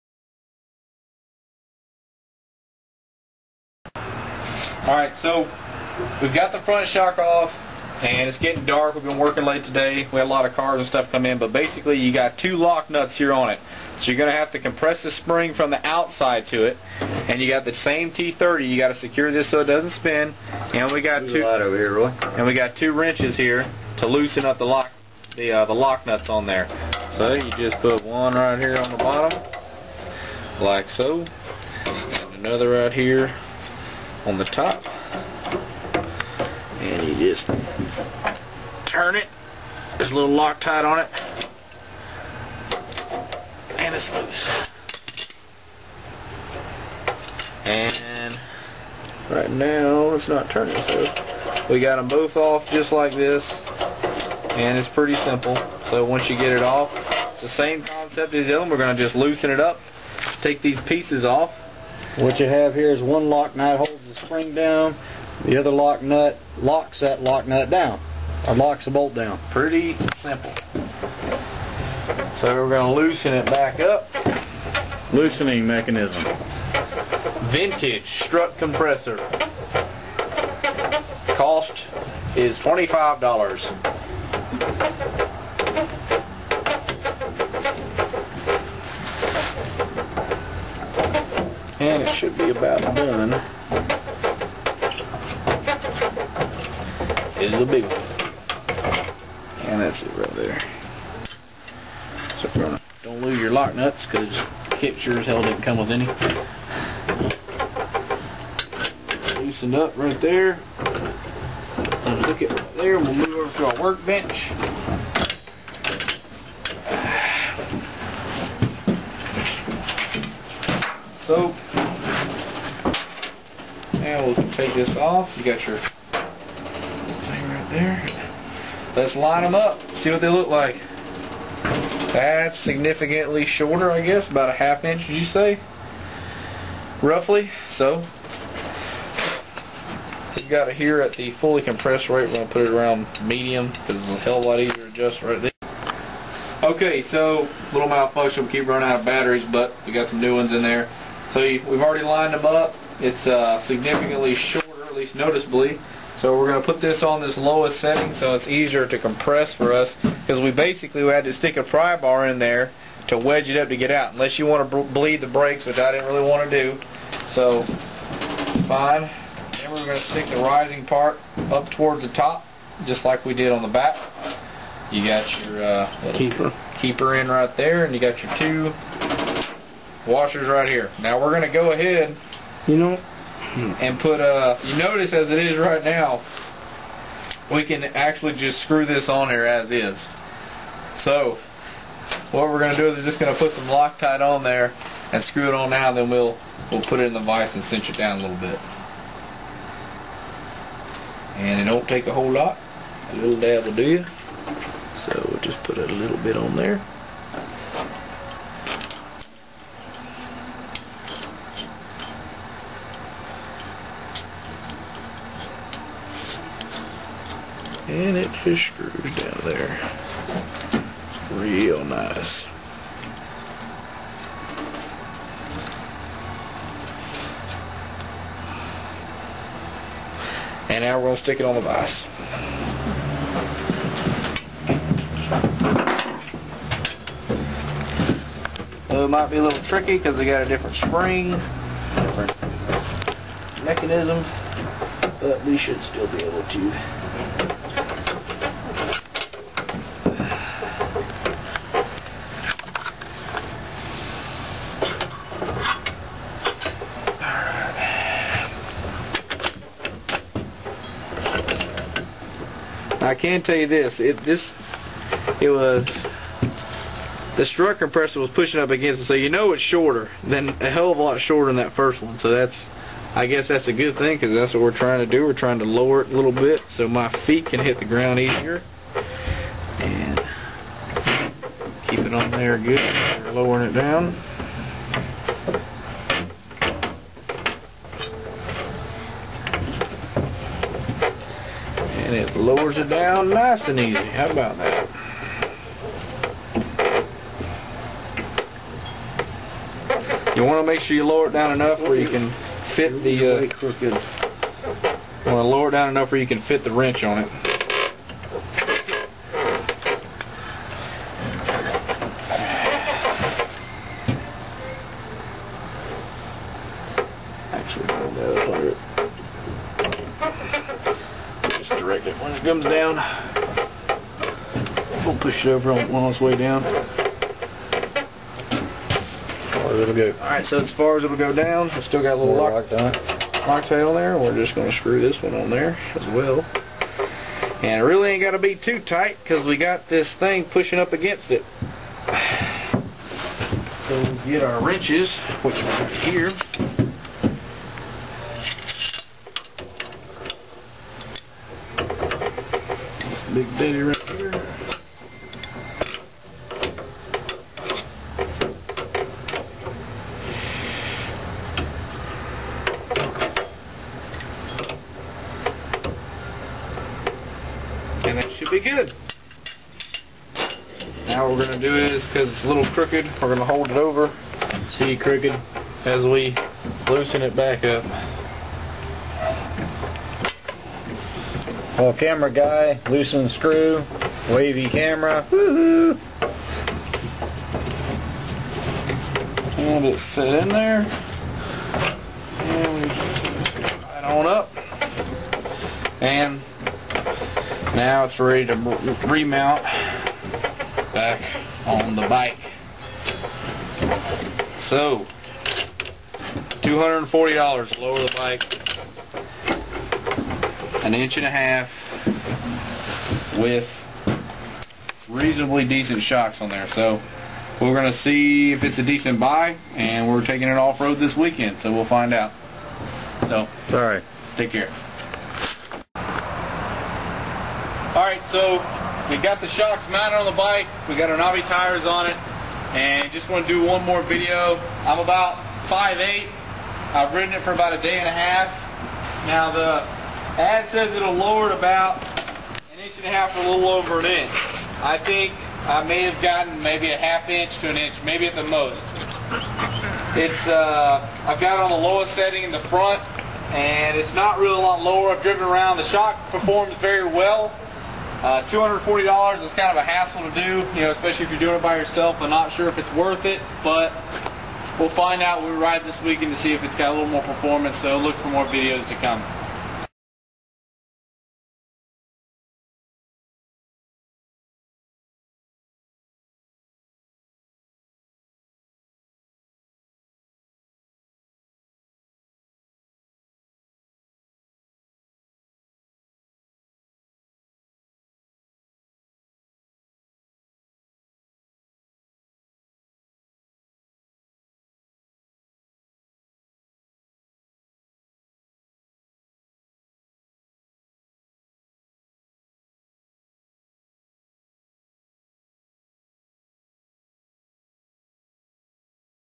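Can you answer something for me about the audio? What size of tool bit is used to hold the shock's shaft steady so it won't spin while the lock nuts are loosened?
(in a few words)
T30.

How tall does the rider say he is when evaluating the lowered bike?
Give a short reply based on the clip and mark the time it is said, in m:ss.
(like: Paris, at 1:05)
5'8", at 7:15.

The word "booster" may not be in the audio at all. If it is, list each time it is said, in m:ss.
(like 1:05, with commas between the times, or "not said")
not said.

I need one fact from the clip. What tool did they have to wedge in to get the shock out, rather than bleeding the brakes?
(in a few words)
pry bar.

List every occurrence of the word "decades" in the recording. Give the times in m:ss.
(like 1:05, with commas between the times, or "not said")
not said.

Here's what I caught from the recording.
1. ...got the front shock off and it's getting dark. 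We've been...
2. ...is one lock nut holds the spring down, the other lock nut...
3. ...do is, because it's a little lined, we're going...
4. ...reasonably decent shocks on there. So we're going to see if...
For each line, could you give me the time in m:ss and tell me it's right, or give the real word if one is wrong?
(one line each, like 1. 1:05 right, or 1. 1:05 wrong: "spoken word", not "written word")
1. 0:06 right
2. 1:02 right
3. 6:11 wrong: "crooked", not "lined"
4. 6:55 right.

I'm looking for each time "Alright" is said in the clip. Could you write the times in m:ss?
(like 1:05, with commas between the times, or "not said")
0:04, 5:30.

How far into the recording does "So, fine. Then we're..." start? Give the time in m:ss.
2:47.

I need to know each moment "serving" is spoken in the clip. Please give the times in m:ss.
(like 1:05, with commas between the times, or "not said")
not said.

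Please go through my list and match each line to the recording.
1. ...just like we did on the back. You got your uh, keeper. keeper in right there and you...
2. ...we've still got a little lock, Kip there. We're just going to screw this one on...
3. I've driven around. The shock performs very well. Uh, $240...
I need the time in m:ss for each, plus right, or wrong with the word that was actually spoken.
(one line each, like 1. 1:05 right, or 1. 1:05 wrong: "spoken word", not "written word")
1. 2:52 right
2. 5:31 wrong: "Loctite", not "Kip"
3. 7:35 right.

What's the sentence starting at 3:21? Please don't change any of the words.
And it don't take a whole lot.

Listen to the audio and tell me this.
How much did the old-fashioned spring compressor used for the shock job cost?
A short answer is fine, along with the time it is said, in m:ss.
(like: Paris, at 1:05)
$25, at 1:21.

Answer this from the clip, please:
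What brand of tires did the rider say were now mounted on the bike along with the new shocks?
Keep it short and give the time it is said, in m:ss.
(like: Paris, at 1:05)
Navi, at 7:11.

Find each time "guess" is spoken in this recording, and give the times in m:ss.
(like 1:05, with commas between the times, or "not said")
2:14, 4:33.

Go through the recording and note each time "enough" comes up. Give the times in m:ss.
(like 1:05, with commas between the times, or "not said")
5:01, 5:05.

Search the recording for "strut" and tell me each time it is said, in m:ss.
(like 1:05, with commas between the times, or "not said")
1:18, 4:27.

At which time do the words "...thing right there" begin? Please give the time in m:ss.
2:06.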